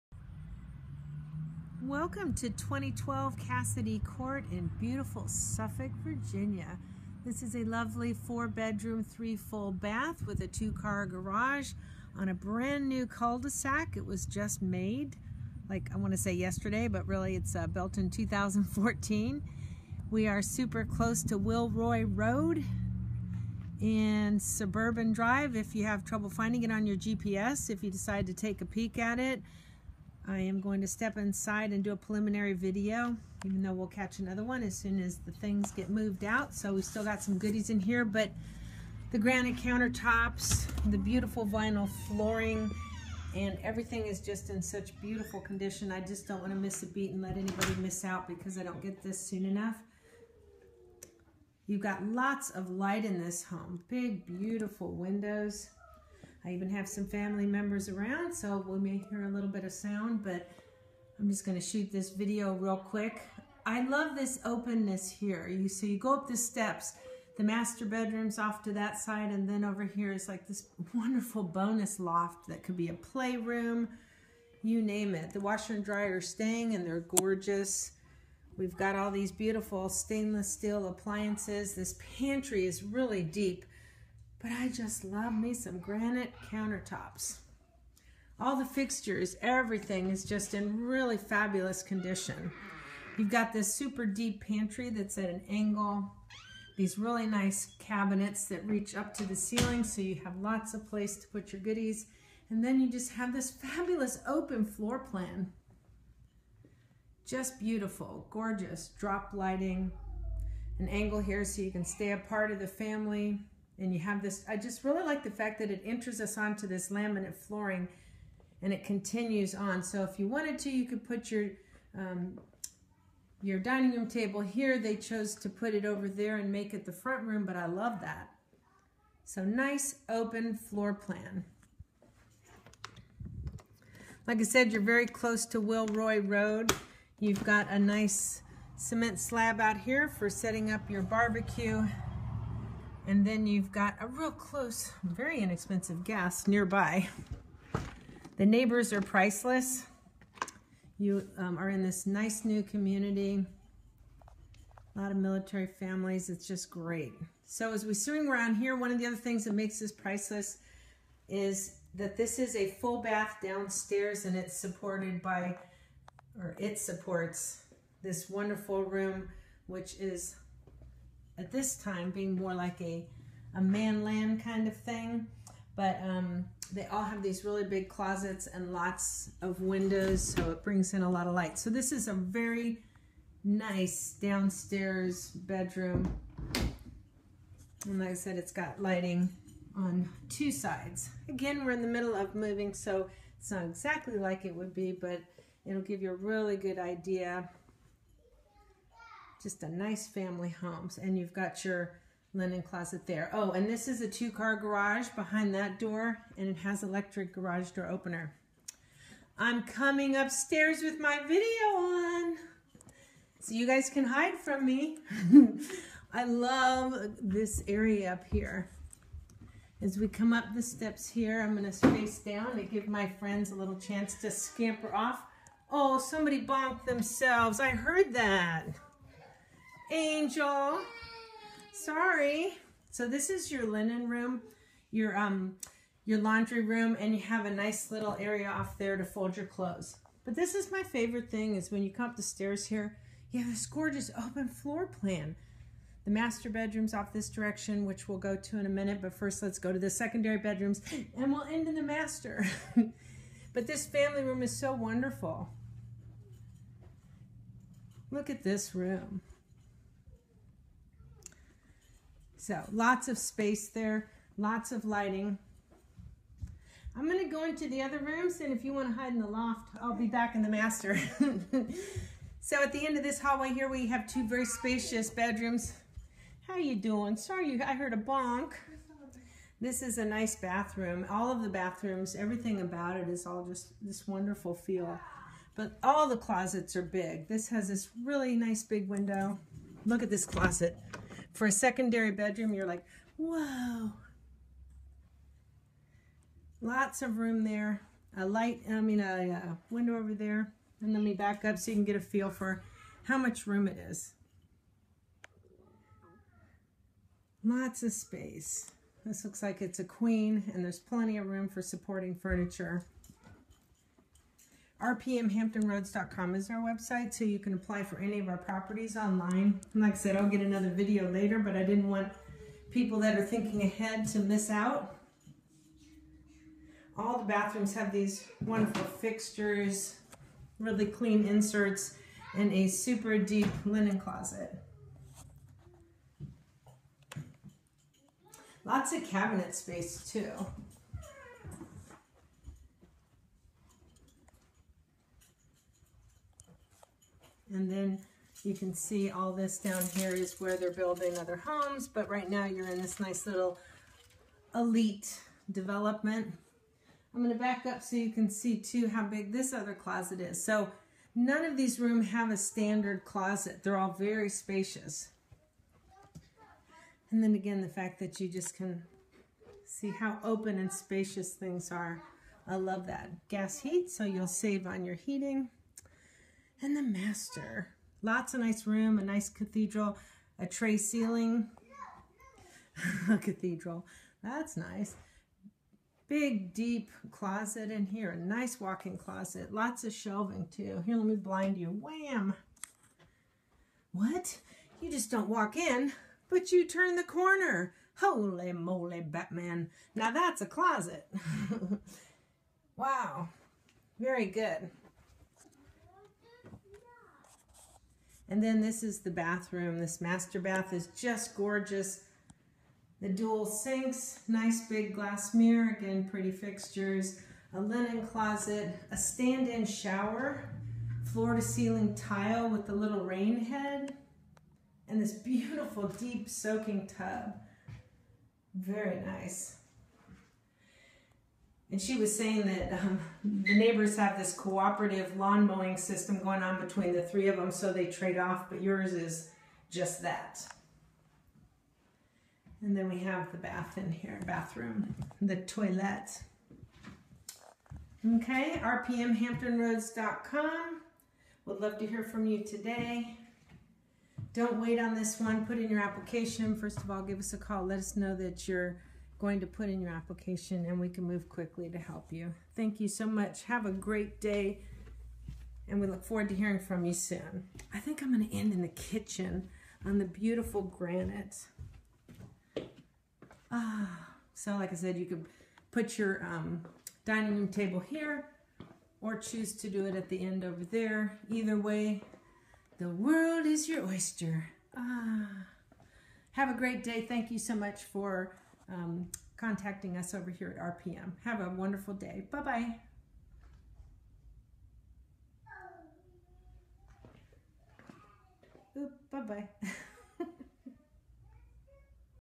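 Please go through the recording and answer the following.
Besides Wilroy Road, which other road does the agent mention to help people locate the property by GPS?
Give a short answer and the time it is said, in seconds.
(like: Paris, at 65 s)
Suburban Drive, at 24 s.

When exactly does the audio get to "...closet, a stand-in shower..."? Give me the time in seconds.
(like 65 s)
418 s.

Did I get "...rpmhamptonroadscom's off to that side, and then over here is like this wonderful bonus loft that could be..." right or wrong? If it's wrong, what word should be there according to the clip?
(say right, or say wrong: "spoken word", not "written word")
wrong: "bedroom", not "rpmhamptonroadscom".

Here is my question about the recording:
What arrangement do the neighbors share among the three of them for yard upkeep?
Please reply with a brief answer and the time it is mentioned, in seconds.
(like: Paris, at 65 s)
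cooperative lawn mowing system, at 434 s.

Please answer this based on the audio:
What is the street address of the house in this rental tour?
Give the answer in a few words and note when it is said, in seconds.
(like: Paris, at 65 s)
2012 Cassidy Court, at 2 s.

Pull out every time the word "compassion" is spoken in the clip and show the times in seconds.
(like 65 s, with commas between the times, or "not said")
not said.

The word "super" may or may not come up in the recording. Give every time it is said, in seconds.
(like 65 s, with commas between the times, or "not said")
20 s, 93 s, 332 s.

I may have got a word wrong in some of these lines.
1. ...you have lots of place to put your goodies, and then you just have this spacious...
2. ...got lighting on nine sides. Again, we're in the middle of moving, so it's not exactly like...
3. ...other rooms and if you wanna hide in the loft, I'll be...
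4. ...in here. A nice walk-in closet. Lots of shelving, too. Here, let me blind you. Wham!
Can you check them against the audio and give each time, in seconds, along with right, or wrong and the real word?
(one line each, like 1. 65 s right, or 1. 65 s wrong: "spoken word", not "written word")
1. 100 s wrong: "fabulous", not "spacious"
2. 188 s wrong: "two", not "nine"
3. 267 s right
4. 387 s right.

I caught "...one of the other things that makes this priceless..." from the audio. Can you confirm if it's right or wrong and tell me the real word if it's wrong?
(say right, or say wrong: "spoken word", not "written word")
right.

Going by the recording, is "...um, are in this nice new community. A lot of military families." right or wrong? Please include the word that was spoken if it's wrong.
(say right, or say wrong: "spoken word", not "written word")
right.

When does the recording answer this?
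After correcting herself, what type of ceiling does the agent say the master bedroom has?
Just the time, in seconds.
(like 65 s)
380 s.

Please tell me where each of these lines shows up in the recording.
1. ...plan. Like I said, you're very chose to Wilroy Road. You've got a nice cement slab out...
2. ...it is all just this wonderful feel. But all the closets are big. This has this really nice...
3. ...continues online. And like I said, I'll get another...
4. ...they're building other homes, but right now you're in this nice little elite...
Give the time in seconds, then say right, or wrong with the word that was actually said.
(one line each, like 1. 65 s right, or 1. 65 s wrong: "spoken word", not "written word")
1. 130 s wrong: "close", not "chose"
2. 282 s right
3. 318 s wrong: "properties", not "continues"
4. 350 s right.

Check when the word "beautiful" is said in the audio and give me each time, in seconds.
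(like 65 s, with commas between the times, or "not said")
4 s, 40 s, 45 s, 54 s, 79 s, 107 s, 425 s, 470 s.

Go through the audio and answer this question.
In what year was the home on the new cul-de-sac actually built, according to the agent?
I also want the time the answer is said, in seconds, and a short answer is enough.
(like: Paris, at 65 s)
2014, at 18 s.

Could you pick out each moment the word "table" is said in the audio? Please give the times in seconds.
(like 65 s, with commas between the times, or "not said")
124 s, 477 s.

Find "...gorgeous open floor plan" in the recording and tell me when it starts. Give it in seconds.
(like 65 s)
243 s.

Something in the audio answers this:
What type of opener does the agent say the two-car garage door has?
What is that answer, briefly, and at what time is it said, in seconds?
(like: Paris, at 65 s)
electric, at 206 s.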